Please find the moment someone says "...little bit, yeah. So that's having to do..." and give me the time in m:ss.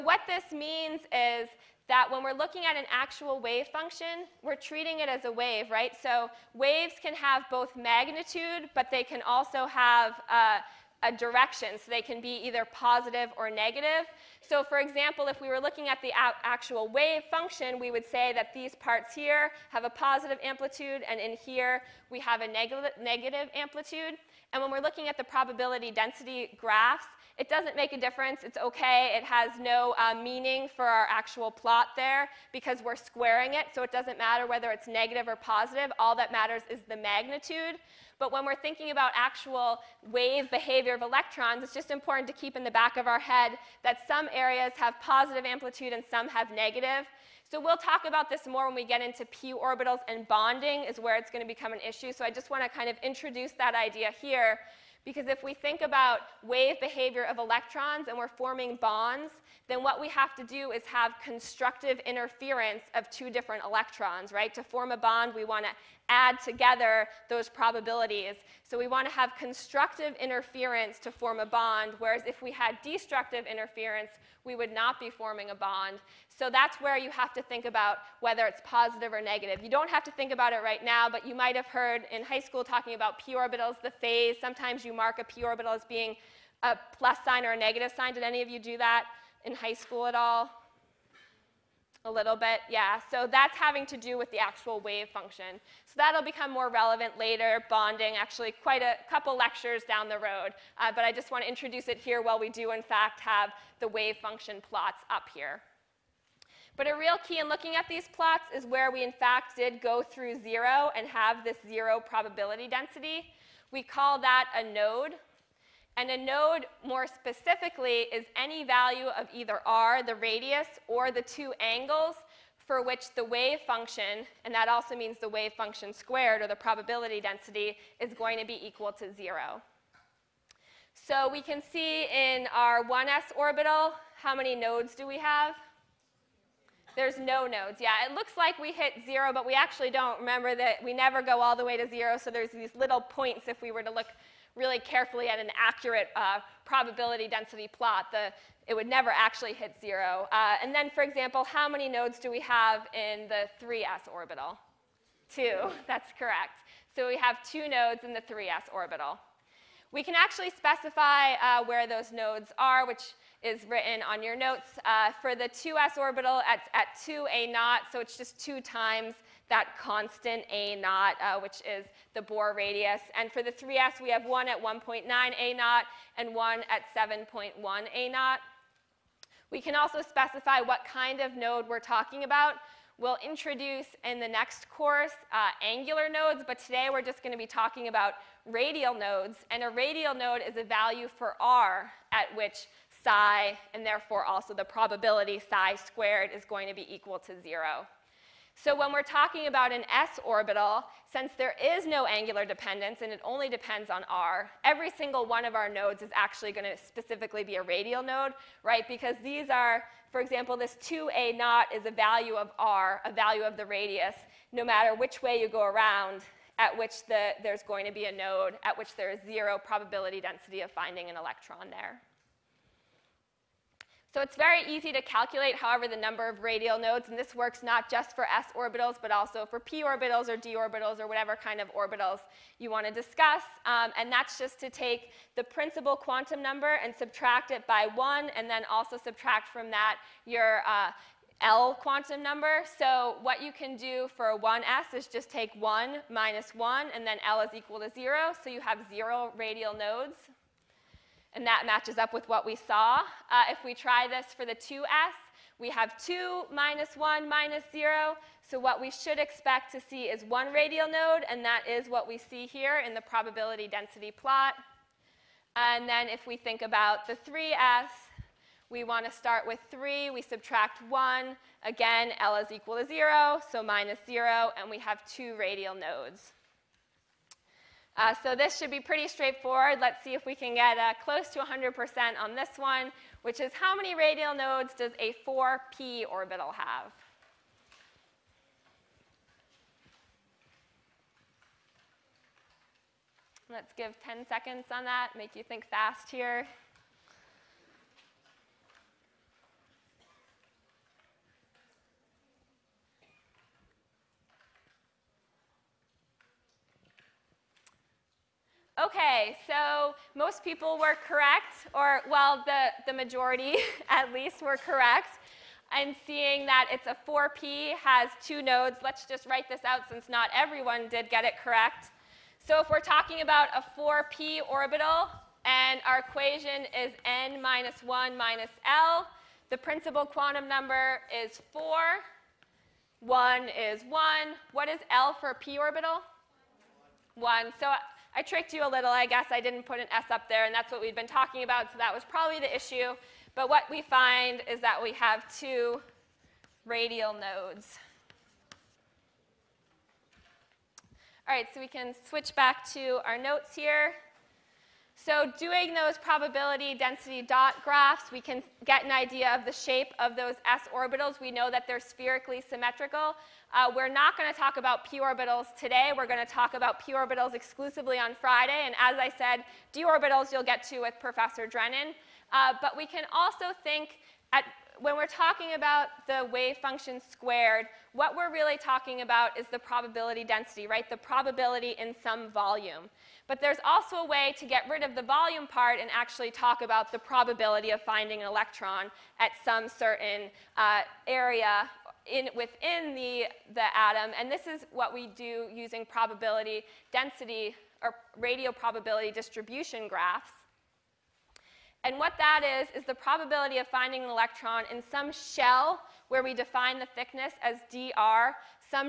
1:32.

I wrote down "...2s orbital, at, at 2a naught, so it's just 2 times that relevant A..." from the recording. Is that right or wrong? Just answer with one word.
wrong.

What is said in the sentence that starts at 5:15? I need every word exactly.
And seeing that it's a 4p has two nodes, let's just write this out since not everyone did get it correct.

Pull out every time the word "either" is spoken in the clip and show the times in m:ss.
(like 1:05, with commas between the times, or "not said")
0:12, 1:59.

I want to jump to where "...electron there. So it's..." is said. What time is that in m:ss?
3:41.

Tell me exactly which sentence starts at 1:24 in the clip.
Sometimes you mark a p orbital as being a plus sign or a negative sign.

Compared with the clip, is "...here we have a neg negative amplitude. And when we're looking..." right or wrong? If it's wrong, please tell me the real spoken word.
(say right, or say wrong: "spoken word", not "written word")
right.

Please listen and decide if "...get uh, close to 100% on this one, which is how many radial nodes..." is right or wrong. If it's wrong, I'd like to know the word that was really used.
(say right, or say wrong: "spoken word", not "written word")
right.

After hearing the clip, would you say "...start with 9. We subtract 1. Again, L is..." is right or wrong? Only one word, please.
wrong.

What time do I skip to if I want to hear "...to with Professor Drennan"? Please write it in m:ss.
6:10.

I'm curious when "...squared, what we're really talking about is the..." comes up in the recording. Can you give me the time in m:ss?
6:17.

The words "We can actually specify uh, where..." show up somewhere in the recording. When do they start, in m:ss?
2:39.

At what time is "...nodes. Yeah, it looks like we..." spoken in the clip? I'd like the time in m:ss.
2:17.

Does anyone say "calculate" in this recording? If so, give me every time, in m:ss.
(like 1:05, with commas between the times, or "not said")
3:45.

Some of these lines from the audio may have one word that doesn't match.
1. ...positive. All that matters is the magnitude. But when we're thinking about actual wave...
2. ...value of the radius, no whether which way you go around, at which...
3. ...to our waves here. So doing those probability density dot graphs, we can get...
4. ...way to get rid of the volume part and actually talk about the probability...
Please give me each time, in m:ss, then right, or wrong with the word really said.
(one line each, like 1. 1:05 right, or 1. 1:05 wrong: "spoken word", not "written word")
1. 0:35 right
2. 3:33 wrong: "matter", not "whether"
3. 5:52 wrong: "notes", not "waves"
4. 6:24 right.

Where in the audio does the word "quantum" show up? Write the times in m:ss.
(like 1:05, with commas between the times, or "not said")
3:55, 4:01, 5:30.